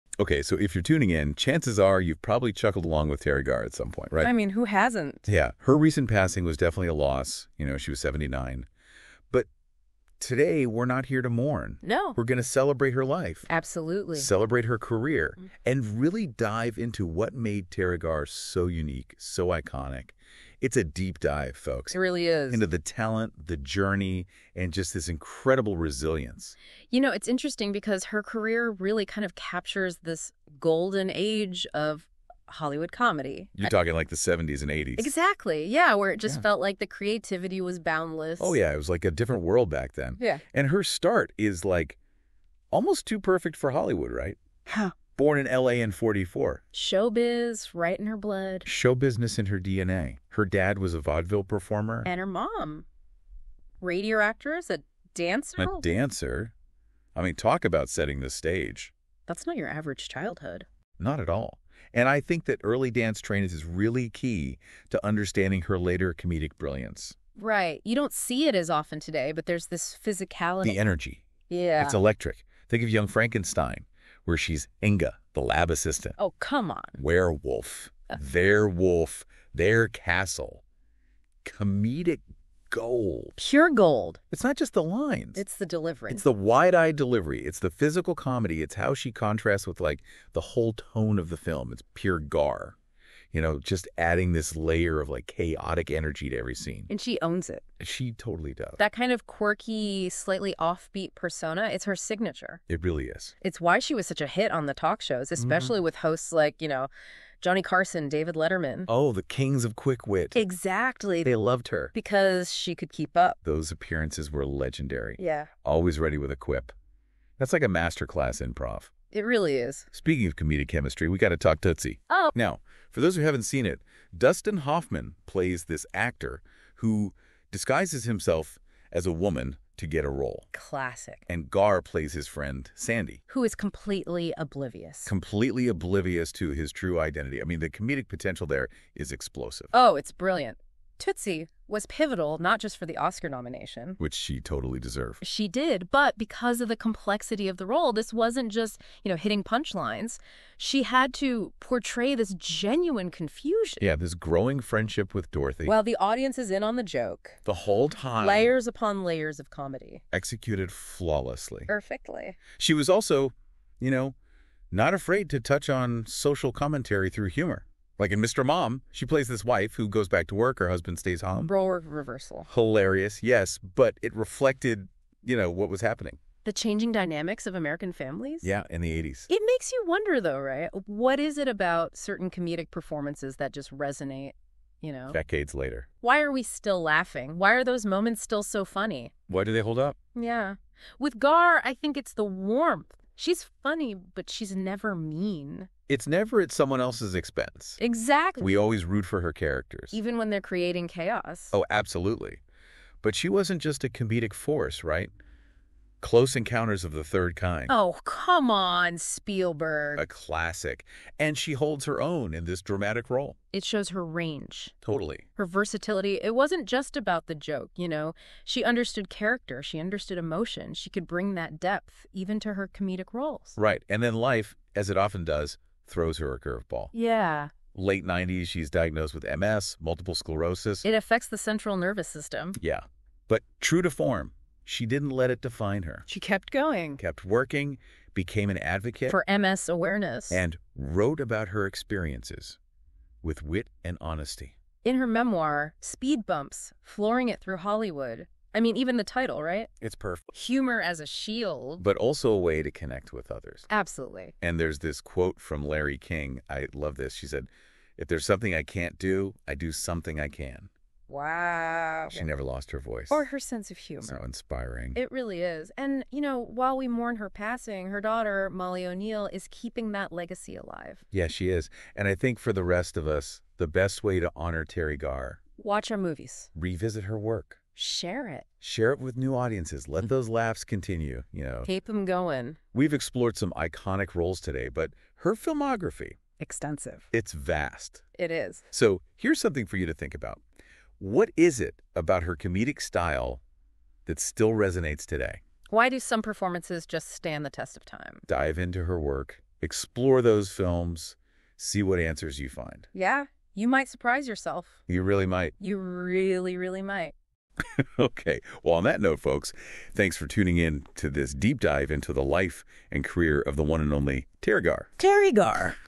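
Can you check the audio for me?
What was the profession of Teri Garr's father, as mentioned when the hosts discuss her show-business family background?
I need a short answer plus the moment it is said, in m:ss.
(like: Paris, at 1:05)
Vaudeville performer, at 0:51.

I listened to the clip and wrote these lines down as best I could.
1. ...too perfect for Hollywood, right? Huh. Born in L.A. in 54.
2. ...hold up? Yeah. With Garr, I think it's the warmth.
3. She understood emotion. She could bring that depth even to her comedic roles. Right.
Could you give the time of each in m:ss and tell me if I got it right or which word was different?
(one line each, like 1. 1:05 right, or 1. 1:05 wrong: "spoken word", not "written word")
1. 0:43 wrong: "44", not "54"
2. 3:09 right
3. 3:39 right.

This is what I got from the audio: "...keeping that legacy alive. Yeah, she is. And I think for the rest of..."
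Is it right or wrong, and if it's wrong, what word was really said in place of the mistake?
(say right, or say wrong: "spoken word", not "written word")
right.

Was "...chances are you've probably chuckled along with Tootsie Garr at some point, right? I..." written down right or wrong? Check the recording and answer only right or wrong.
wrong.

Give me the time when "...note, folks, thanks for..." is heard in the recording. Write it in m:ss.
5:09.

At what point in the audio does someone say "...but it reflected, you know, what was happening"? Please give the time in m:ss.
2:53.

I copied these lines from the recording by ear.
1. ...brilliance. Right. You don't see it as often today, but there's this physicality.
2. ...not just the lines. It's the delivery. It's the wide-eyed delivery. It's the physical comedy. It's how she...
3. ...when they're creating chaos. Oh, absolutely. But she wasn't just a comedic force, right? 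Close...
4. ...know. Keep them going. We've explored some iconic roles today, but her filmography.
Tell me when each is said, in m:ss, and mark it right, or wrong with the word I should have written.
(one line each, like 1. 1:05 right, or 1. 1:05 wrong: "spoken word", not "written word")
1. 1:06 right
2. 1:24 right
3. 3:20 right
4. 4:41 right.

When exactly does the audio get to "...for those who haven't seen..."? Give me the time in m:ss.
2:02.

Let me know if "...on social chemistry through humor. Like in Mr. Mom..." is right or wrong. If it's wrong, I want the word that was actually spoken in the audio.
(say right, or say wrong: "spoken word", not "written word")
wrong: "commentary", not "chemistry".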